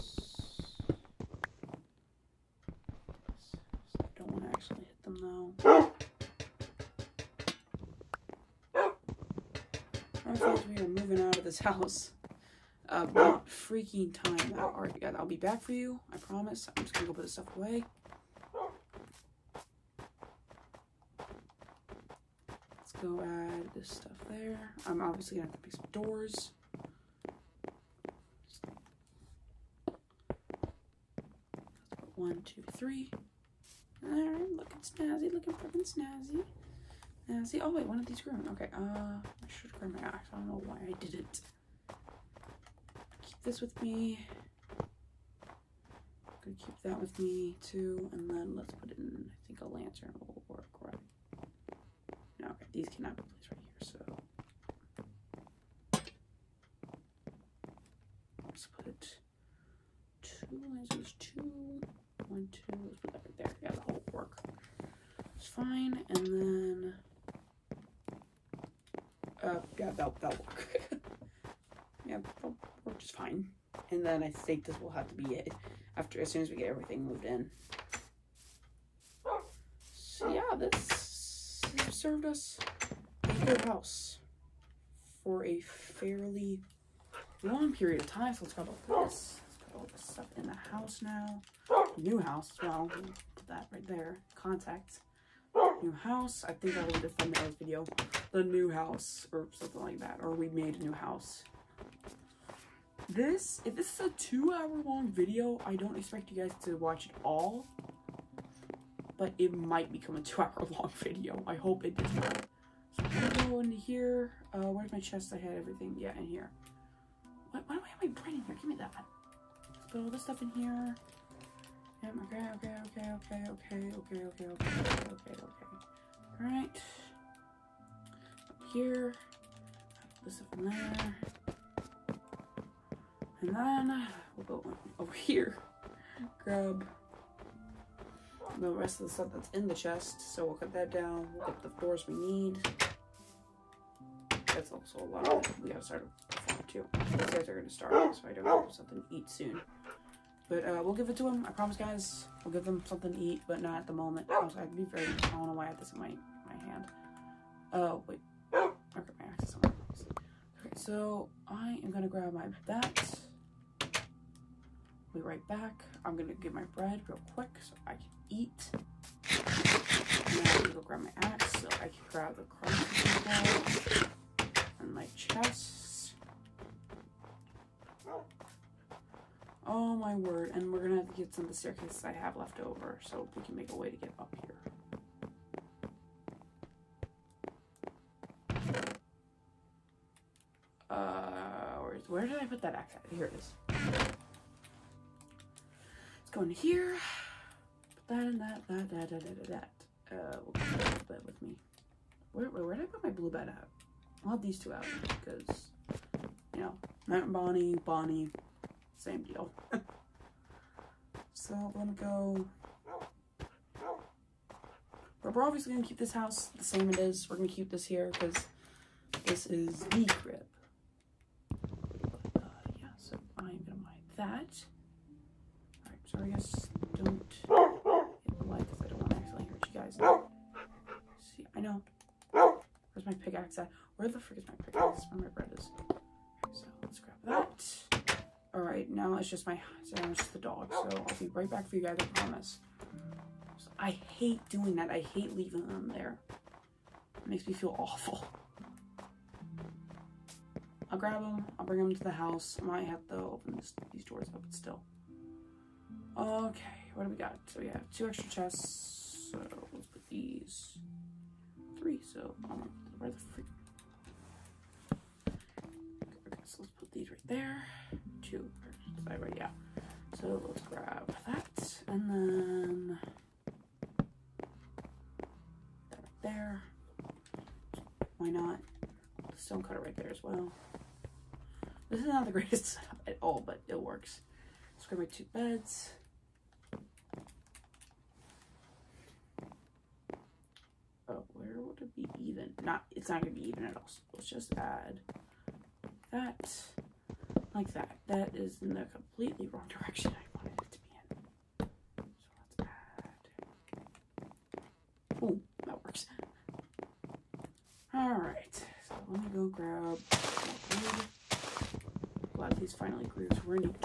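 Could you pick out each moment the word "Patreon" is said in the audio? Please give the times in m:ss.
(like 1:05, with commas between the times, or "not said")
not said.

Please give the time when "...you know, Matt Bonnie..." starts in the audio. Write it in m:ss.
3:26.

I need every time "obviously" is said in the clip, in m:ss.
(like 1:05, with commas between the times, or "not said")
0:25, 3:35.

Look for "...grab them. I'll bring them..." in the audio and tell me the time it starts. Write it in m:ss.
4:10.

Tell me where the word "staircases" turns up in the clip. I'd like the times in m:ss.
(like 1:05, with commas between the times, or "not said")
3:01.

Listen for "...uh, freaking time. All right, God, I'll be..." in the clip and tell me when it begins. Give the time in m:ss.
0:13.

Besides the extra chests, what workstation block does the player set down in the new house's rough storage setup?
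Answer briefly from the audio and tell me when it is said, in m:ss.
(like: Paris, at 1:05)
stone cutter, at 4:39.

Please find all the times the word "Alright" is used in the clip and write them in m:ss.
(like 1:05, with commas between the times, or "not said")
3:45, 3:58.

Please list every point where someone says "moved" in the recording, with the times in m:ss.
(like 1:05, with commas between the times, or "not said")
1:17.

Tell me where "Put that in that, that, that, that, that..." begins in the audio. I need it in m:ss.
3:18.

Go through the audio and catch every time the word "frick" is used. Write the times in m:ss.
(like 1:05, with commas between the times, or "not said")
3:54.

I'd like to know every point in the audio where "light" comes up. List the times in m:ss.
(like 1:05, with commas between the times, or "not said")
3:48.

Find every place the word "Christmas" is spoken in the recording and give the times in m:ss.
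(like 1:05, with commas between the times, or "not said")
not said.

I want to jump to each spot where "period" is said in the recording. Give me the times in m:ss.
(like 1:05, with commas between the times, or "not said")
1:27.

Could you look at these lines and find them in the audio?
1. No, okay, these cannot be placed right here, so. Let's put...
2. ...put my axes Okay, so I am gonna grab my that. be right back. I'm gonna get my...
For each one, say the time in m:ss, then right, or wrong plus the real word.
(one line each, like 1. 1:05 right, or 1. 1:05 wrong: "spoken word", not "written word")
1. 0:52 right
2. 2:39 right.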